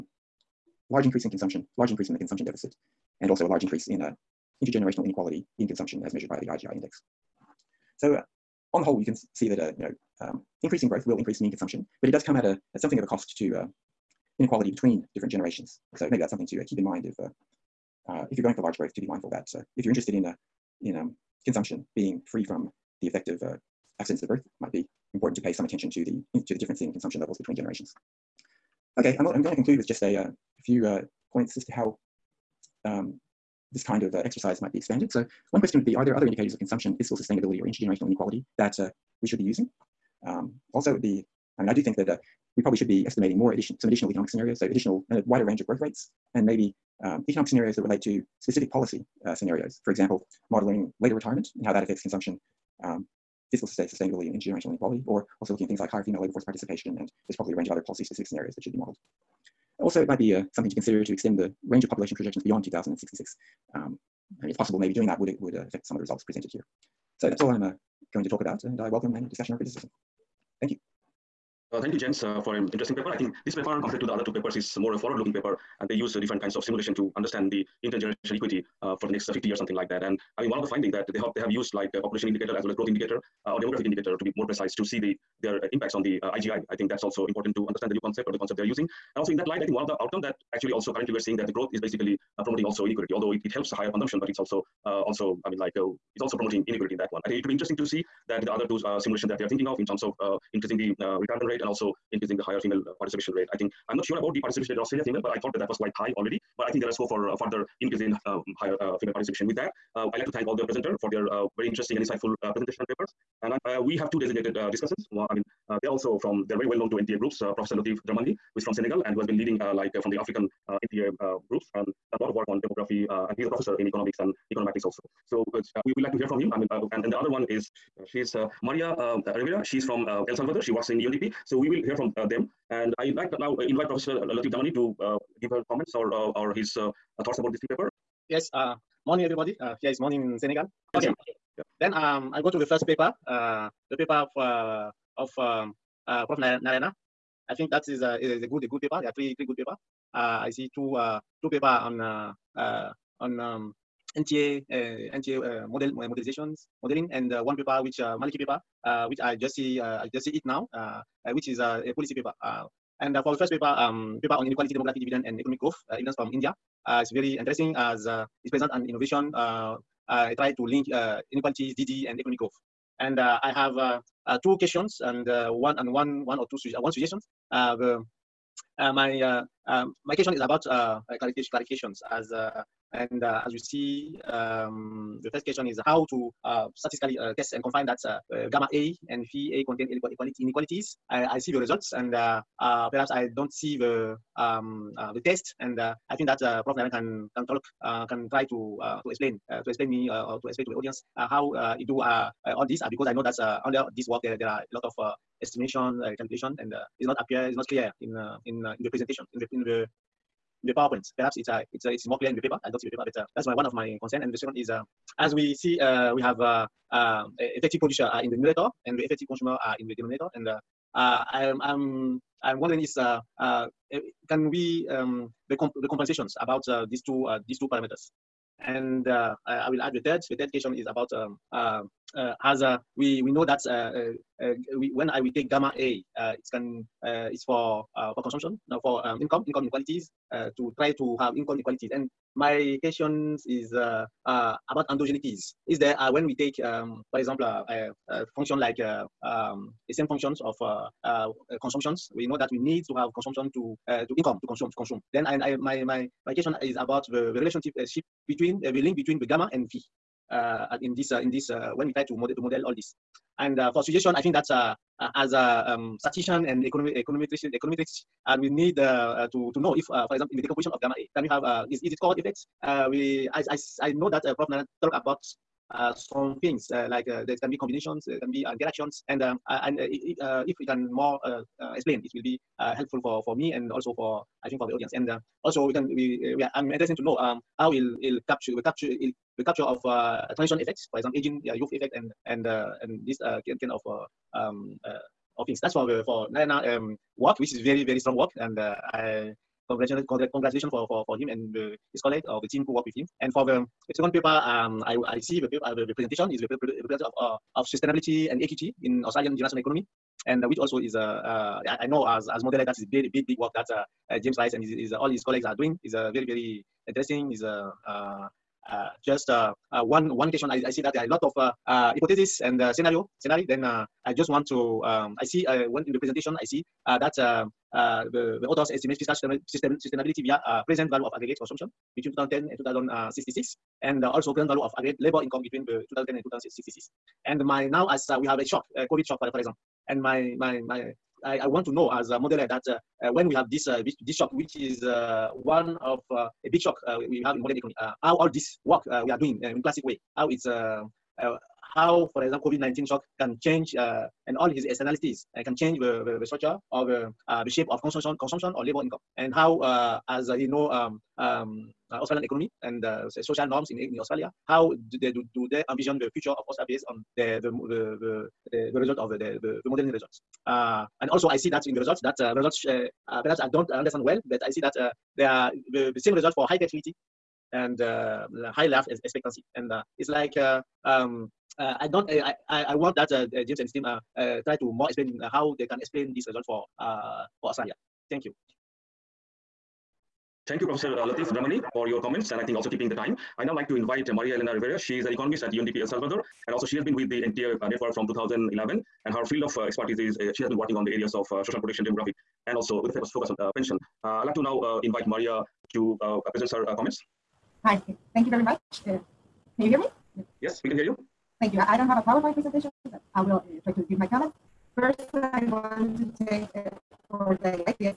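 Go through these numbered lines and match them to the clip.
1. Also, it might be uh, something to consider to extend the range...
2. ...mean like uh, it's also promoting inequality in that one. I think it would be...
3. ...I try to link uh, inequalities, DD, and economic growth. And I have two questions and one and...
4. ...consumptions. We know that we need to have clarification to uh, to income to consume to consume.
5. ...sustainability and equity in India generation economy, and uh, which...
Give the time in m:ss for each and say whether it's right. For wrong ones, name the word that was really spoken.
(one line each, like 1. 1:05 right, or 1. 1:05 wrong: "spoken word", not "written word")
1. 0:59 right
2. 1:35 right
3. 2:50 right
4. 4:11 wrong: "consumption", not "clarification"
5. 5:07 wrong: "Australian", not "India".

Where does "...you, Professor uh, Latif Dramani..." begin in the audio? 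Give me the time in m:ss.
6:30.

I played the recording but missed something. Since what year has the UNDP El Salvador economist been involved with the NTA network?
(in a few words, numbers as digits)
2011.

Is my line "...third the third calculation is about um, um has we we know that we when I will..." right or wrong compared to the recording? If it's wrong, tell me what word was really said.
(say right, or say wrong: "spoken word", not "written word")
wrong: "question", not "calculation".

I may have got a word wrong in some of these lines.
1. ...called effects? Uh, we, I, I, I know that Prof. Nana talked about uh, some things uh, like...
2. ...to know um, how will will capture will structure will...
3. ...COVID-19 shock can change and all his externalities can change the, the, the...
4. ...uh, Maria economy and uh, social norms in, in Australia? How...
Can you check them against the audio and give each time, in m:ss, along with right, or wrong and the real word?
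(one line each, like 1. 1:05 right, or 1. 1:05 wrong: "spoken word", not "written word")
1. 4:32 right
2. 4:46 wrong: "capture", not "structure"
3. 5:52 right
4. 6:01 wrong: "Australian", not "Maria".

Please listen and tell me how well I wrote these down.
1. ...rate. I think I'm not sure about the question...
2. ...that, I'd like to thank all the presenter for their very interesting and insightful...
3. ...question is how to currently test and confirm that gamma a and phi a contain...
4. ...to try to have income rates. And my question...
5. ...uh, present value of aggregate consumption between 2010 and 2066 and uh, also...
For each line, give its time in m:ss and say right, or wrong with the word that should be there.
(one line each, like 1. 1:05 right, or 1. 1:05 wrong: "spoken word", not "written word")
1. 1:43 wrong: "participation", not "question"
2. 1:49 right
3. 3:05 wrong: "statistically", not "currently"
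4. 4:00 wrong: "inequalities", not "rates"
5. 5:30 right.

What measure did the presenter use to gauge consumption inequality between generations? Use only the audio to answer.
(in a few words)
IGI index.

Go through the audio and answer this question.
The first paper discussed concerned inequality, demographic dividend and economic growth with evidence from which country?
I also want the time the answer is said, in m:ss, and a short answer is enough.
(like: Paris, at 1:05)
India, at 2:46.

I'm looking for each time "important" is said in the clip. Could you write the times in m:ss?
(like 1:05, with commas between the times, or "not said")
0:25, 1:27.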